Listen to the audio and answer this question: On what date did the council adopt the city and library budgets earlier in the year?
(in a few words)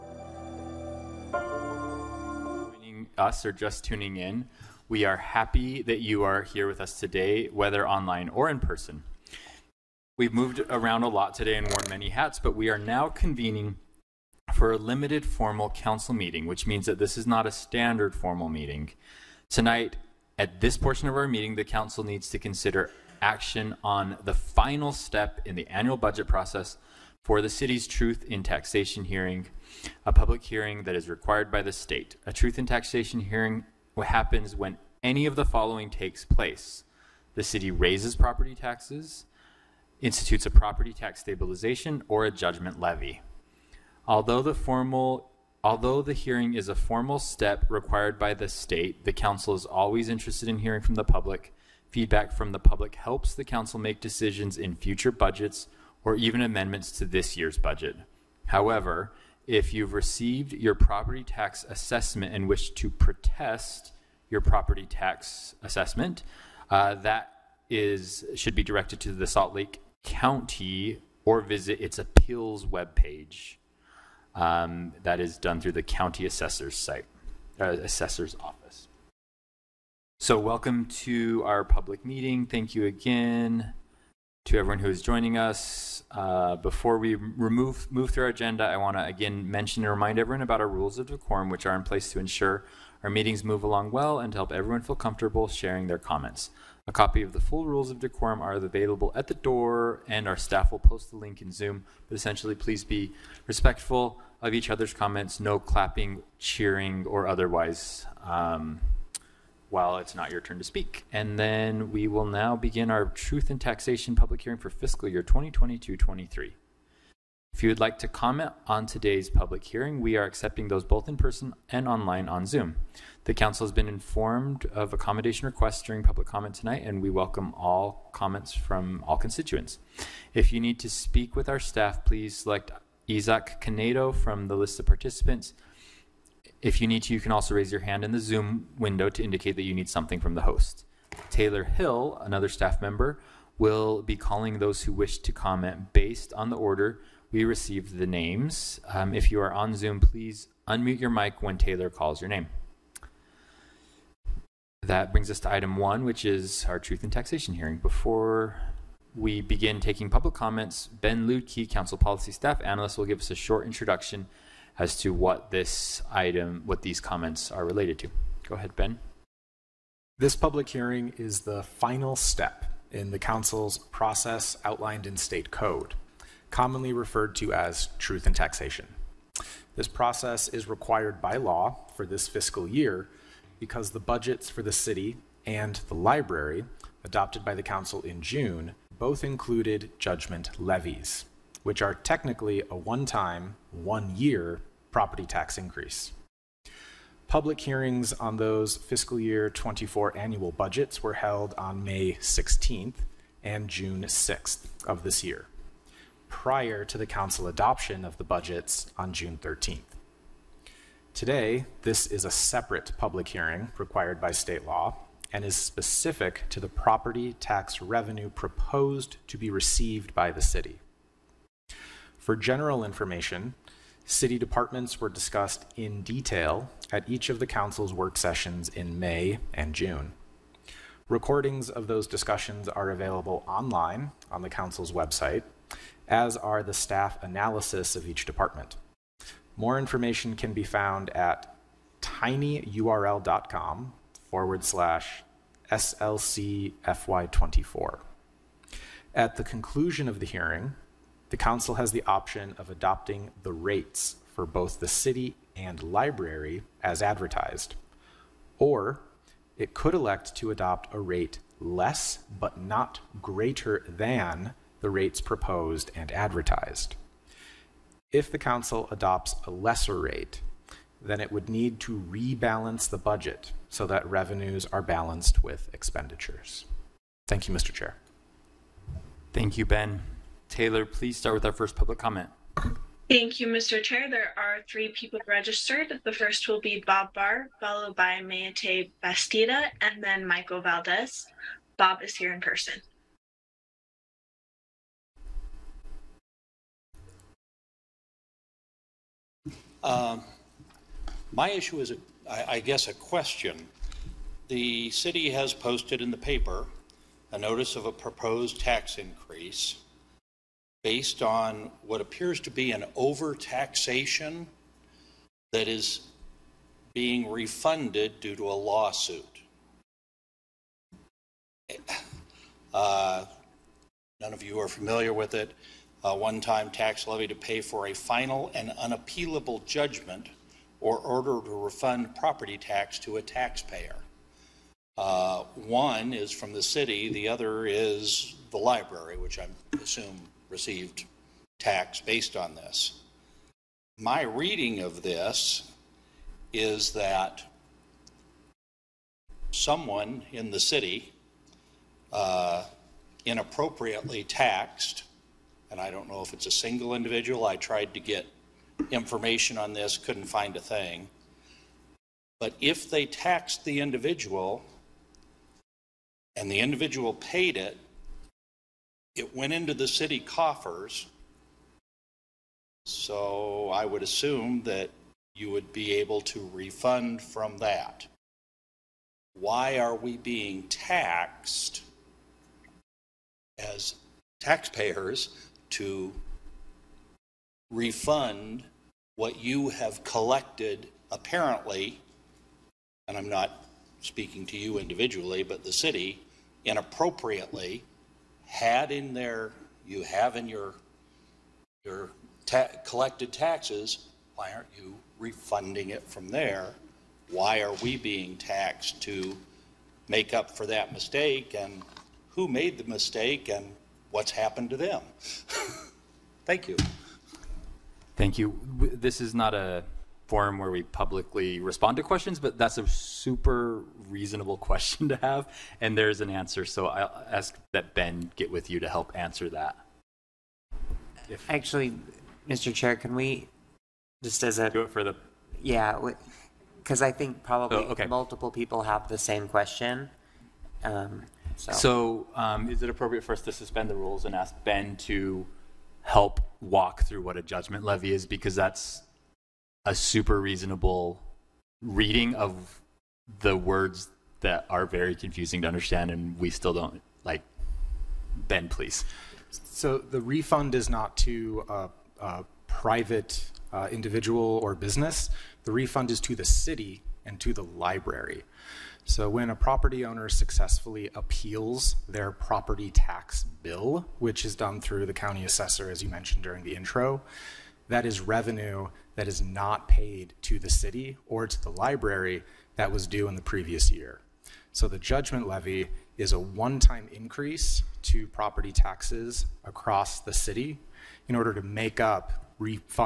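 June 13.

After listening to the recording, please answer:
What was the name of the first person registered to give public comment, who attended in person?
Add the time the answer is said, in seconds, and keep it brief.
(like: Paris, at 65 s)
Bob Barr, at 286 s.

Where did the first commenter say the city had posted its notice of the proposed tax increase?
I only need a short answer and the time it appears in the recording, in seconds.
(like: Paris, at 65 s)
in the paper, at 306 s.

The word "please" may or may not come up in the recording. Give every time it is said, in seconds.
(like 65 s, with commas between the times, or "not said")
102 s, 132 s, 150 s, 280 s, 458 s.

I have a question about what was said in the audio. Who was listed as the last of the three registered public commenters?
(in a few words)
Michael Valdez.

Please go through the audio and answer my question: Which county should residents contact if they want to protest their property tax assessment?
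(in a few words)
Salt Lake County.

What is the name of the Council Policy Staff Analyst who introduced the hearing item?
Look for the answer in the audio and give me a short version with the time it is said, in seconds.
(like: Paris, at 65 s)
Ben Luedtke, at 160 s.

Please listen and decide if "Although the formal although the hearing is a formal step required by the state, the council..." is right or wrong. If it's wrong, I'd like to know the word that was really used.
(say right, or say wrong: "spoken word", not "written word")
right.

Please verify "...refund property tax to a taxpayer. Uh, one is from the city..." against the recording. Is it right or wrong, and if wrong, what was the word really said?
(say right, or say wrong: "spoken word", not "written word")
right.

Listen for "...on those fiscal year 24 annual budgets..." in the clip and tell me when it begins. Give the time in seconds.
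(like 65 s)
198 s.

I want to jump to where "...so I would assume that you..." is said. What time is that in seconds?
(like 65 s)
372 s.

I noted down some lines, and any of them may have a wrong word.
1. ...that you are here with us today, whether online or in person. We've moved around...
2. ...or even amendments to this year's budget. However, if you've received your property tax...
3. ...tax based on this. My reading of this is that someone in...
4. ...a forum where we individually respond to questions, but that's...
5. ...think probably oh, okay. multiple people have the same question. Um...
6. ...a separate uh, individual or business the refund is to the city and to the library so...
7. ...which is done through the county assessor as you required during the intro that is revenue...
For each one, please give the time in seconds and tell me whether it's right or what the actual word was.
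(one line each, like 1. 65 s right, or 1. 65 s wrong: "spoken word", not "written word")
1. 5 s right
2. 56 s right
3. 341 s right
4. 419 s wrong: "publicly", not "individually"
5. 437 s right
6. 462 s wrong: "private", not "separate"
7. 474 s wrong: "mentioned", not "required".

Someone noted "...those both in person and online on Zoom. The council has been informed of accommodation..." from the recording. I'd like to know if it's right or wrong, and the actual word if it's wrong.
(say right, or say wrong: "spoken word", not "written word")
right.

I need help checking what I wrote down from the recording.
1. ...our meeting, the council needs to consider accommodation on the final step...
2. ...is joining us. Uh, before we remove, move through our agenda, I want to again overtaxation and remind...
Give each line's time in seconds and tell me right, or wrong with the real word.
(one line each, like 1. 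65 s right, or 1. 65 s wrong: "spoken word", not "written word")
1. 21 s wrong: "action", not "accommodation"
2. 84 s wrong: "mention", not "overtaxation".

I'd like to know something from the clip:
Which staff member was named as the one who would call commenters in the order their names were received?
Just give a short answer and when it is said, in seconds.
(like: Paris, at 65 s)
Taylor Hill, at 141 s.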